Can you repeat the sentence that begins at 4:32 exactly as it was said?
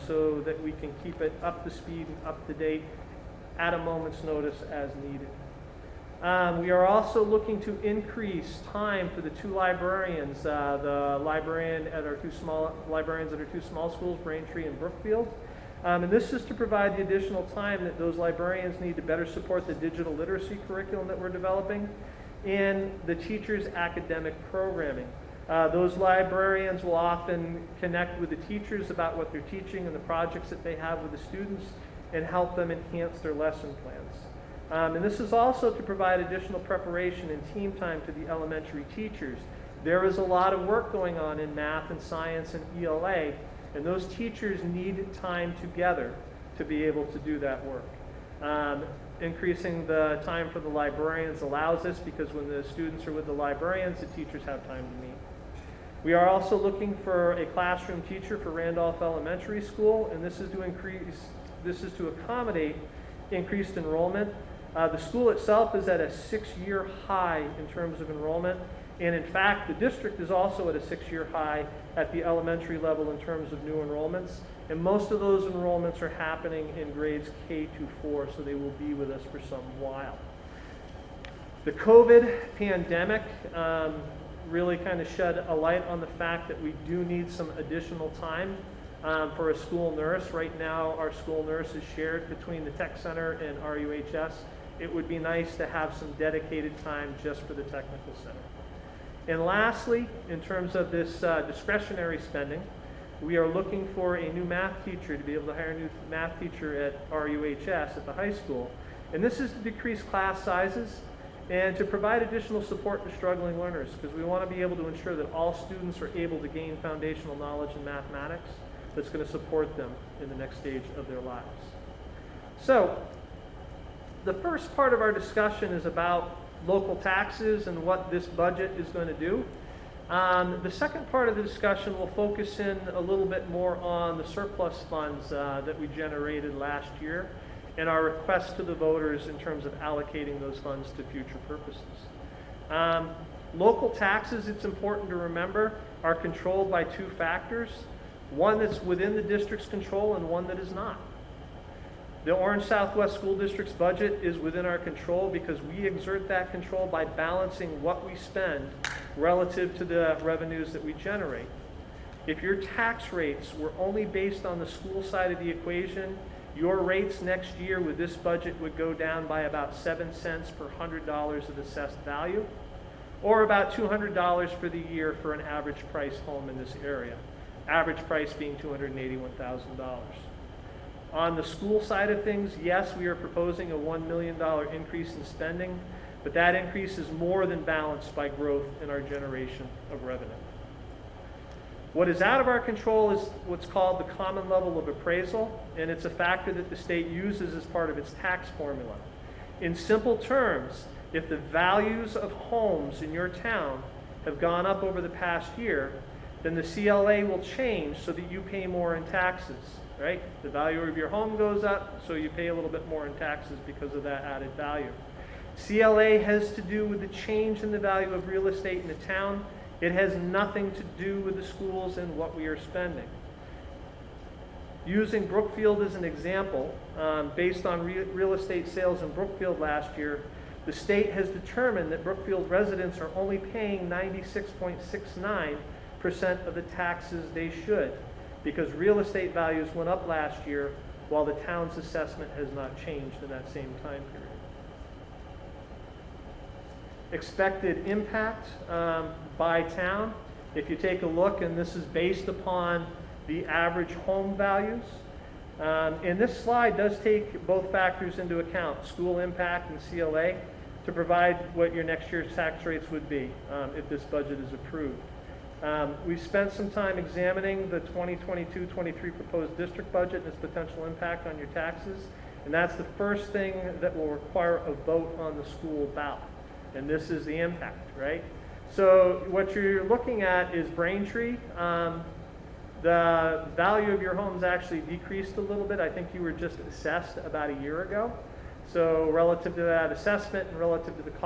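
And that's the first thing that will require a vote on the school ballot.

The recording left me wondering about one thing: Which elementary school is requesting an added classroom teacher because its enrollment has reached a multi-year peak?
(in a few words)
Randolph Elementary School.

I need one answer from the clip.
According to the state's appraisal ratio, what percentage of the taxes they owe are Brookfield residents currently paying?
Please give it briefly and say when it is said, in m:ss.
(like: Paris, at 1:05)
96.69%, at 3:53.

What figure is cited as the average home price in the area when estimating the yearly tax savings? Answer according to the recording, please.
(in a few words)
$281,000.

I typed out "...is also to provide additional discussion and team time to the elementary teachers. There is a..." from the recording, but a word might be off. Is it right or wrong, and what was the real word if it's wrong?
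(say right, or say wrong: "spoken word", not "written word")
wrong: "preparation", not "discussion".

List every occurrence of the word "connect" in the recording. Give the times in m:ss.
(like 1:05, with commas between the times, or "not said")
0:27.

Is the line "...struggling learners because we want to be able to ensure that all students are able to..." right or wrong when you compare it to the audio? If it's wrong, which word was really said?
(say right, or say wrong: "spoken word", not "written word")
right.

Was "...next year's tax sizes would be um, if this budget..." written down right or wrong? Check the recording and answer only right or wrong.
wrong.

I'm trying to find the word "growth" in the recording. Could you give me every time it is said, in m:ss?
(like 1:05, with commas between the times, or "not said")
3:08.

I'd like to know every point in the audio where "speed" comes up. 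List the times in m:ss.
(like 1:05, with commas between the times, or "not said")
0:01.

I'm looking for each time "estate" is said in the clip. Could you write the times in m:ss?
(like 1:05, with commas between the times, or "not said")
3:38, 3:48, 3:59.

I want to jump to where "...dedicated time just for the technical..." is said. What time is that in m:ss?
1:36.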